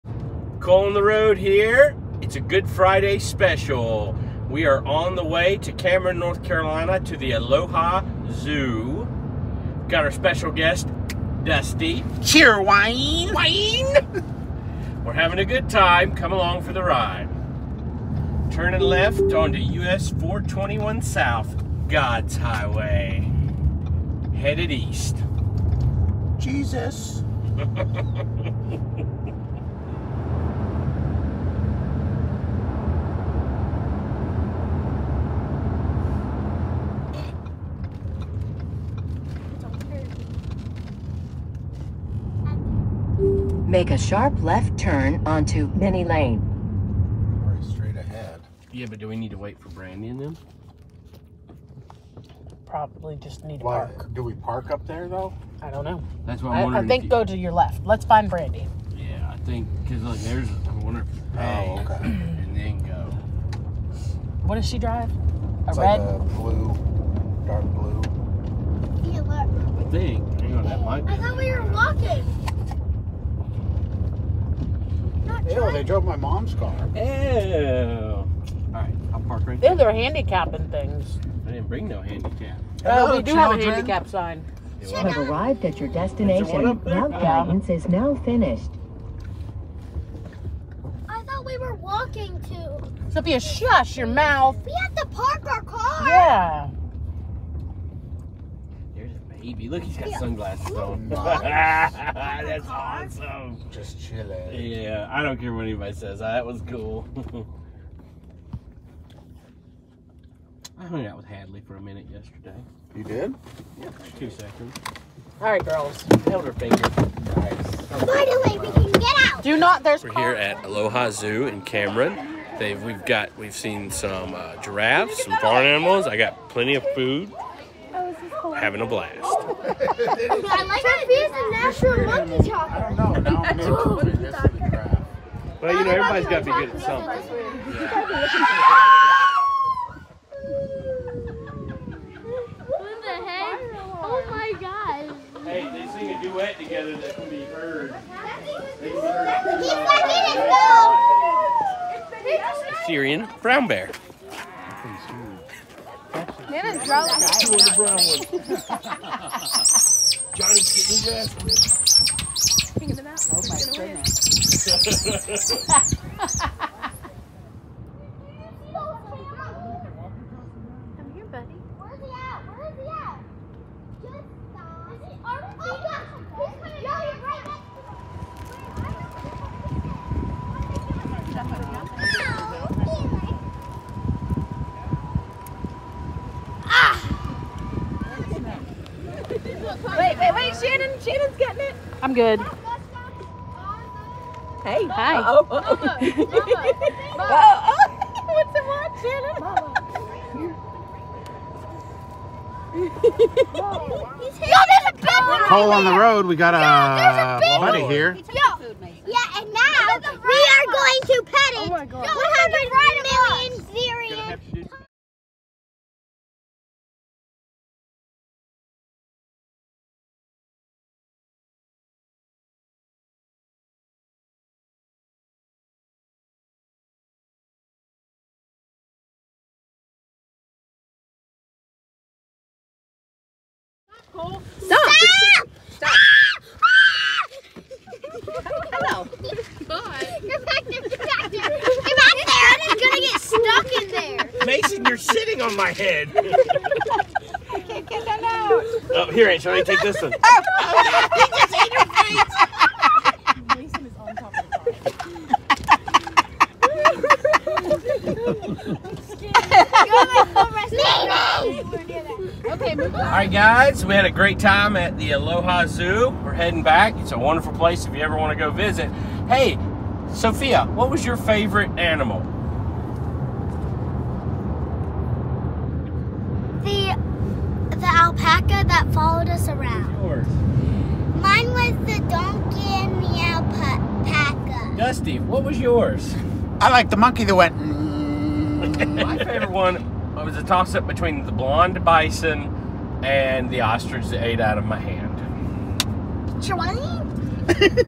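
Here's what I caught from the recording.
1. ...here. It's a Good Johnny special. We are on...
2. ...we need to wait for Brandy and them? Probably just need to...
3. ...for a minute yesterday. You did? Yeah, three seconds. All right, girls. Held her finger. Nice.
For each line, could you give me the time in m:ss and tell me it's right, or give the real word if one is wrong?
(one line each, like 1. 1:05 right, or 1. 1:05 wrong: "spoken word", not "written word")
1. 0:01 wrong: "Friday", not "Johnny"
2. 0:49 right
3. 1:51 wrong: "two", not "three".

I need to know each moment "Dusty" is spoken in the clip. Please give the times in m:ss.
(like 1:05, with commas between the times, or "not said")
0:11, 4:44.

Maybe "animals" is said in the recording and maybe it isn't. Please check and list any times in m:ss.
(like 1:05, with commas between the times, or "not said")
2:05, 4:31.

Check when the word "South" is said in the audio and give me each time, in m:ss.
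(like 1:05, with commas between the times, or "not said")
0:21.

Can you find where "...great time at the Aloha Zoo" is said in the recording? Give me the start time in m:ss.
4:24.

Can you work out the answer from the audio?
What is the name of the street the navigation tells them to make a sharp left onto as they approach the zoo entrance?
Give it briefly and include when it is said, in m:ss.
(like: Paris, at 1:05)
Mini Lane, at 0:45.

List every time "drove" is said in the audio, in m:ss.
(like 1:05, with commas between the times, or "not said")
1:15, 2:36.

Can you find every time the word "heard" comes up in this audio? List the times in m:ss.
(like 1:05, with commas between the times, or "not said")
2:27, 2:32.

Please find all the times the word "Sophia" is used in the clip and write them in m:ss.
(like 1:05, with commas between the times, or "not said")
1:33, 4:30.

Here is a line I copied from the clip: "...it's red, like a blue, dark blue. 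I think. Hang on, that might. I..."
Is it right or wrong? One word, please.
right.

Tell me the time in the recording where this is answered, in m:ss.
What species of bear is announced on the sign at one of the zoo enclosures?
2:32.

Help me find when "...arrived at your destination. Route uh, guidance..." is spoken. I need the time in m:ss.
1:25.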